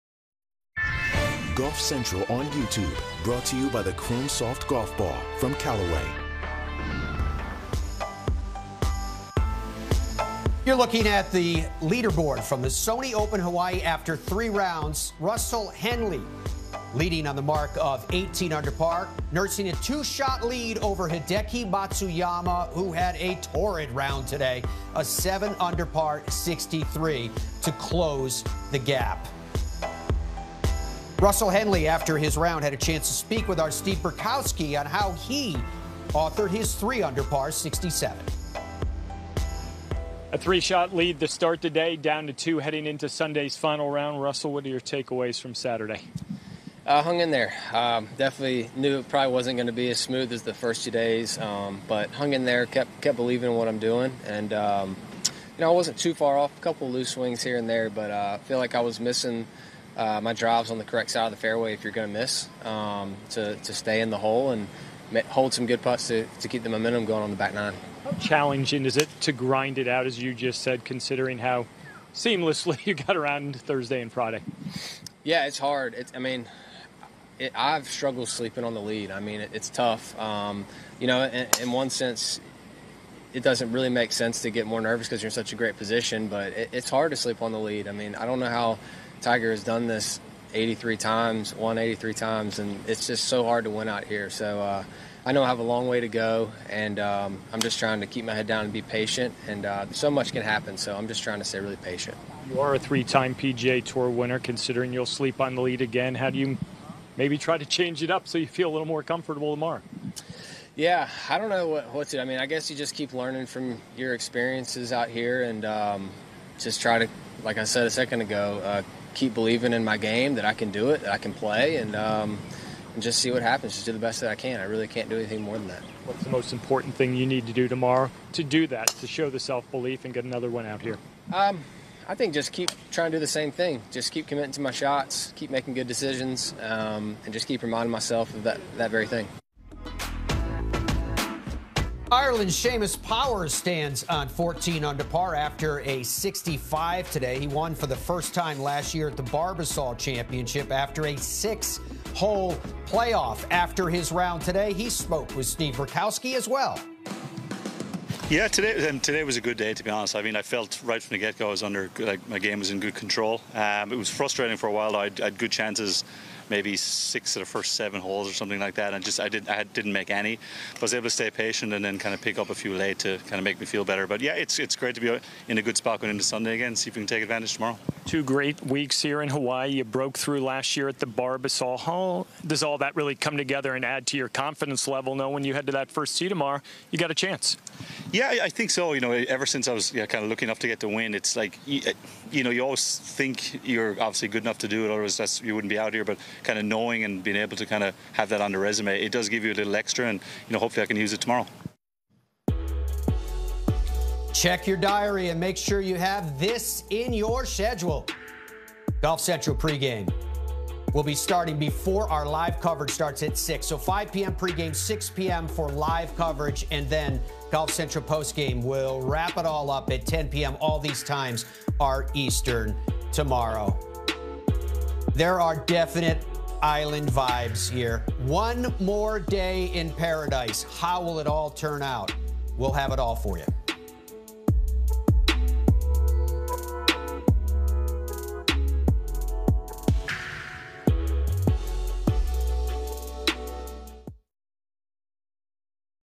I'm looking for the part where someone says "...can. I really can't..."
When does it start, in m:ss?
2:04.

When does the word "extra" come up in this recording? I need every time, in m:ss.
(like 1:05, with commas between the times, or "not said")
3:19.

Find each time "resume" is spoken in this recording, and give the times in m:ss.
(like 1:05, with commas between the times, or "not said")
3:18.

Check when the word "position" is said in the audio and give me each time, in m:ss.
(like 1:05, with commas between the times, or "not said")
1:25.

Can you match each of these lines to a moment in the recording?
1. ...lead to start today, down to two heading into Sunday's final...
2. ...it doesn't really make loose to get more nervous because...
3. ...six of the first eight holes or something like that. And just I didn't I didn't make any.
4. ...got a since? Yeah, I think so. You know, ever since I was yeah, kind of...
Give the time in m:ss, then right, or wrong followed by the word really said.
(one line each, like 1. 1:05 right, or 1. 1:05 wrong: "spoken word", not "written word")
1. 0:40 right
2. 1:23 wrong: "sense", not "loose"
3. 2:46 wrong: "seven", not "eight"
4. 3:06 wrong: "chance", not "since".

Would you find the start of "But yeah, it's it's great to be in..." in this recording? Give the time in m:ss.
2:54.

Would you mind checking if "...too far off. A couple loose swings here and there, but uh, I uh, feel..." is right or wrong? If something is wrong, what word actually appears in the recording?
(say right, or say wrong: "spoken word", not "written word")
right.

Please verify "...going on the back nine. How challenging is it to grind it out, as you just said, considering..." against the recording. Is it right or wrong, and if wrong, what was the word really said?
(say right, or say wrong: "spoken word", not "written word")
right.